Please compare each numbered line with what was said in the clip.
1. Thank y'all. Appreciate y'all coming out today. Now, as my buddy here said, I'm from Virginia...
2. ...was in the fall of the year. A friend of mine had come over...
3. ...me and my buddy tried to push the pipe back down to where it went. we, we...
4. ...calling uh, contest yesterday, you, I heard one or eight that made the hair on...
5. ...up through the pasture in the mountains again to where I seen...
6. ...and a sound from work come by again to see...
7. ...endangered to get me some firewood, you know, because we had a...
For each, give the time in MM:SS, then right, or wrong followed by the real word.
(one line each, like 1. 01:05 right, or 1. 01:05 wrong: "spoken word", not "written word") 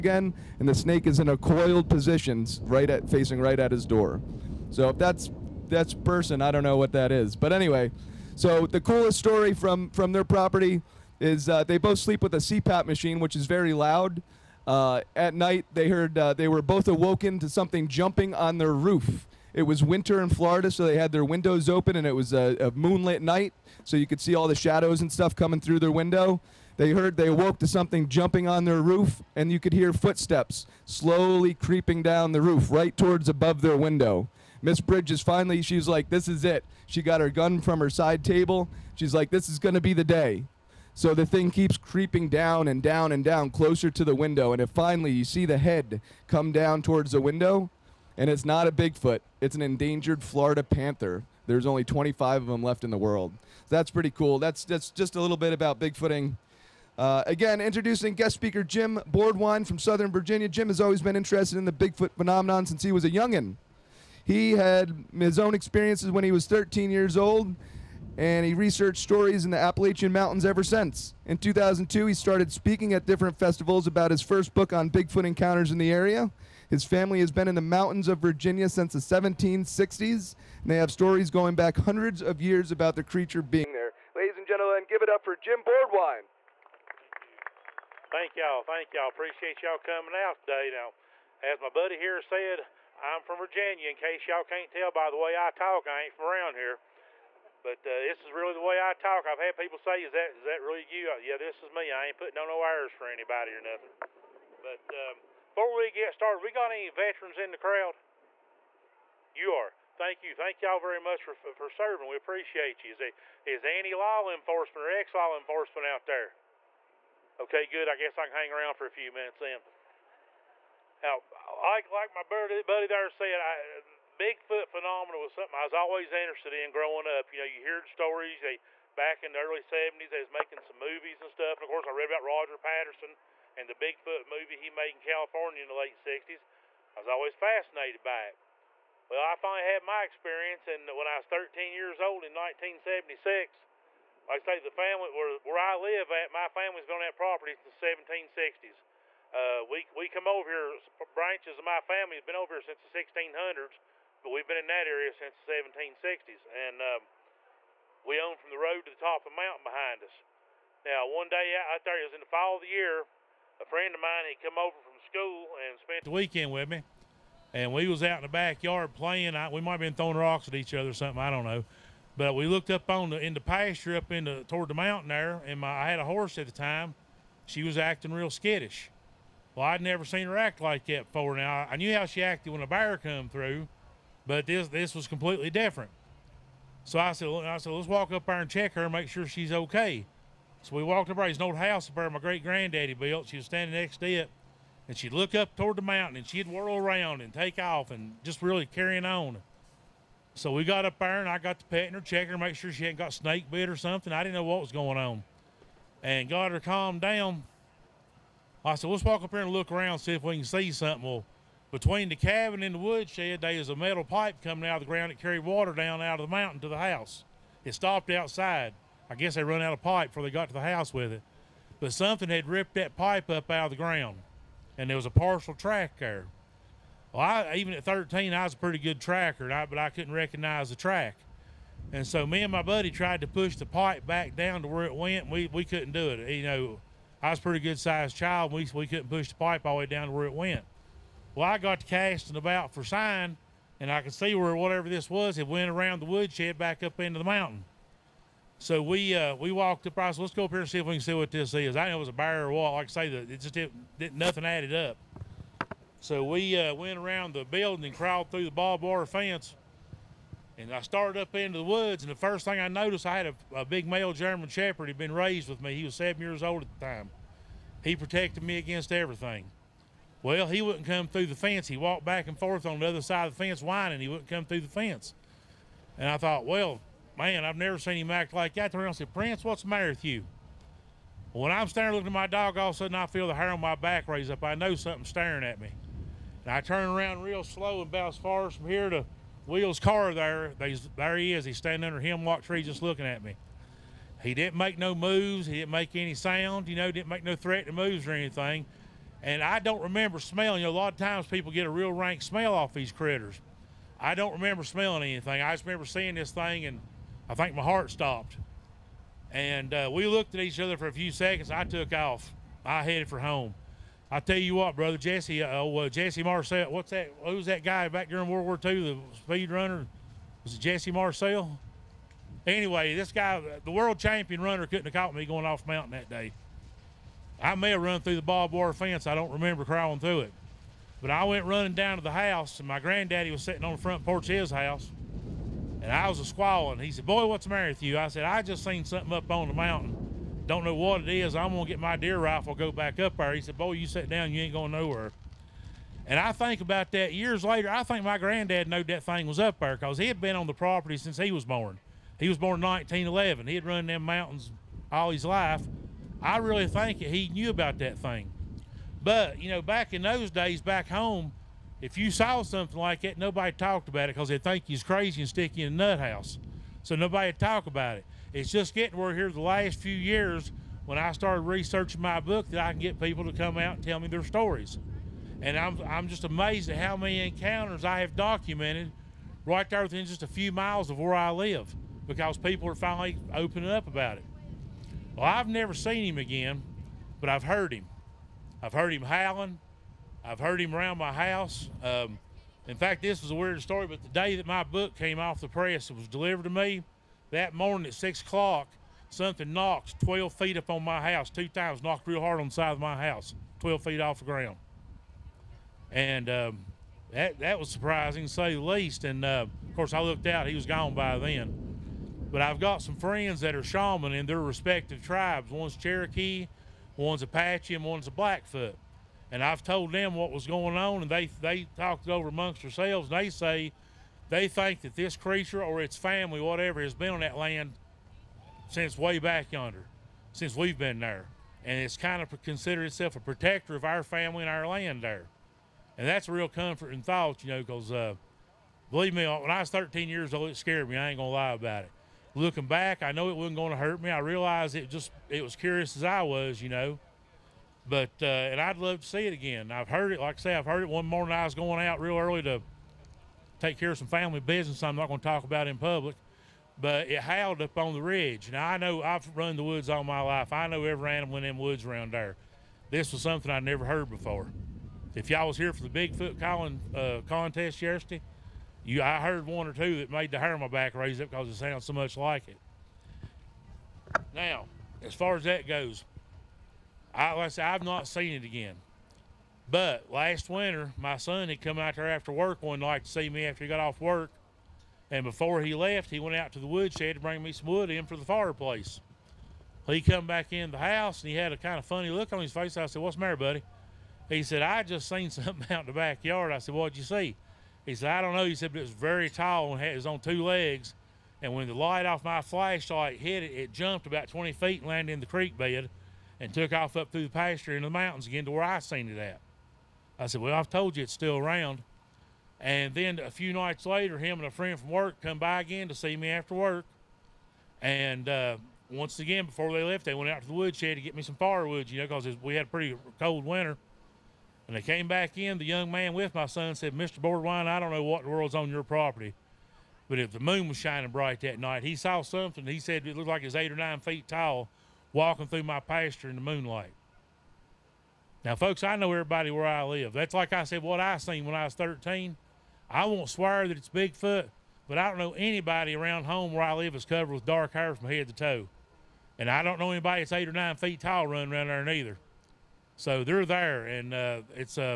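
1. 01:28 right
2. 02:42 right
3. 03:52 right
4. 07:46 wrong: "two", not "eight"
5. 08:26 right
6. 08:34 wrong: "friend", not "sound"
7. 08:40 wrong: "woodshed", not "endangered".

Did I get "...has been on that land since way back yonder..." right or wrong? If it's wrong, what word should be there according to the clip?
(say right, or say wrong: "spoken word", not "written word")
right.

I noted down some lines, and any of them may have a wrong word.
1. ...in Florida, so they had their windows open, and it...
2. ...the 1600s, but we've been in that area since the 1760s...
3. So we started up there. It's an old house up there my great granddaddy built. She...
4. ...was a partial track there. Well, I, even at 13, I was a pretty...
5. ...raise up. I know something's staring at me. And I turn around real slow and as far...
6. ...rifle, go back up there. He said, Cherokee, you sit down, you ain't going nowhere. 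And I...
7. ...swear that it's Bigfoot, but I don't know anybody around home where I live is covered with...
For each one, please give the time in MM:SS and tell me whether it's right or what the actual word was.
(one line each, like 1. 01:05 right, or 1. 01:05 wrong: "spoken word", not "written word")
1. 00:20 right
2. 02:32 right
3. 03:10 wrong: "walked", not "started"
4. 03:44 right
5. 04:44 right
6. 05:42 wrong: "Boy", not "Cherokee"
7. 09:03 right.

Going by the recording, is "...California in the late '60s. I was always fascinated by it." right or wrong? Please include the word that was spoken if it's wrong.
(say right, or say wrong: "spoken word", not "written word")
right.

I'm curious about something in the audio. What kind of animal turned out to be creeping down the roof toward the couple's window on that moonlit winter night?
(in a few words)
Florida panther.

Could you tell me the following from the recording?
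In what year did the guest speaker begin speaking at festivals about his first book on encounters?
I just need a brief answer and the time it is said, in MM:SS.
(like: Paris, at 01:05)
2002, at 01:11.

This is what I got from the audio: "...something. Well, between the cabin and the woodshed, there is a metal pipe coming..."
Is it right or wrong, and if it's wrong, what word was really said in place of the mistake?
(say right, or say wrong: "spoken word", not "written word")
right.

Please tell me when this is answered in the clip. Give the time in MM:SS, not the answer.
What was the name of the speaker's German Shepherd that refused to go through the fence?
04:39.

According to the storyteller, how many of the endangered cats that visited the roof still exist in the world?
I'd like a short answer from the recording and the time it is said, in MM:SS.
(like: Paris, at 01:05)
25, at 00:51.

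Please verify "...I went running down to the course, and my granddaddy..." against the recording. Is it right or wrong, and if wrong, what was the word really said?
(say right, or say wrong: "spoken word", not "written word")
wrong: "house", not "course".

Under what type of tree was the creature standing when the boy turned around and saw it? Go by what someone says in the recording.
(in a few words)
hemlock.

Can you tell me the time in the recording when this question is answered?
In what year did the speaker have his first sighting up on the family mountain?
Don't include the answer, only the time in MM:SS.
02:22.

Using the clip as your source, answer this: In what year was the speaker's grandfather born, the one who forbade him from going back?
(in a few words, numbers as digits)
1911.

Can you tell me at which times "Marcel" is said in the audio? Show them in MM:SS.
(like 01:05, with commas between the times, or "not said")
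05:16, 05:20.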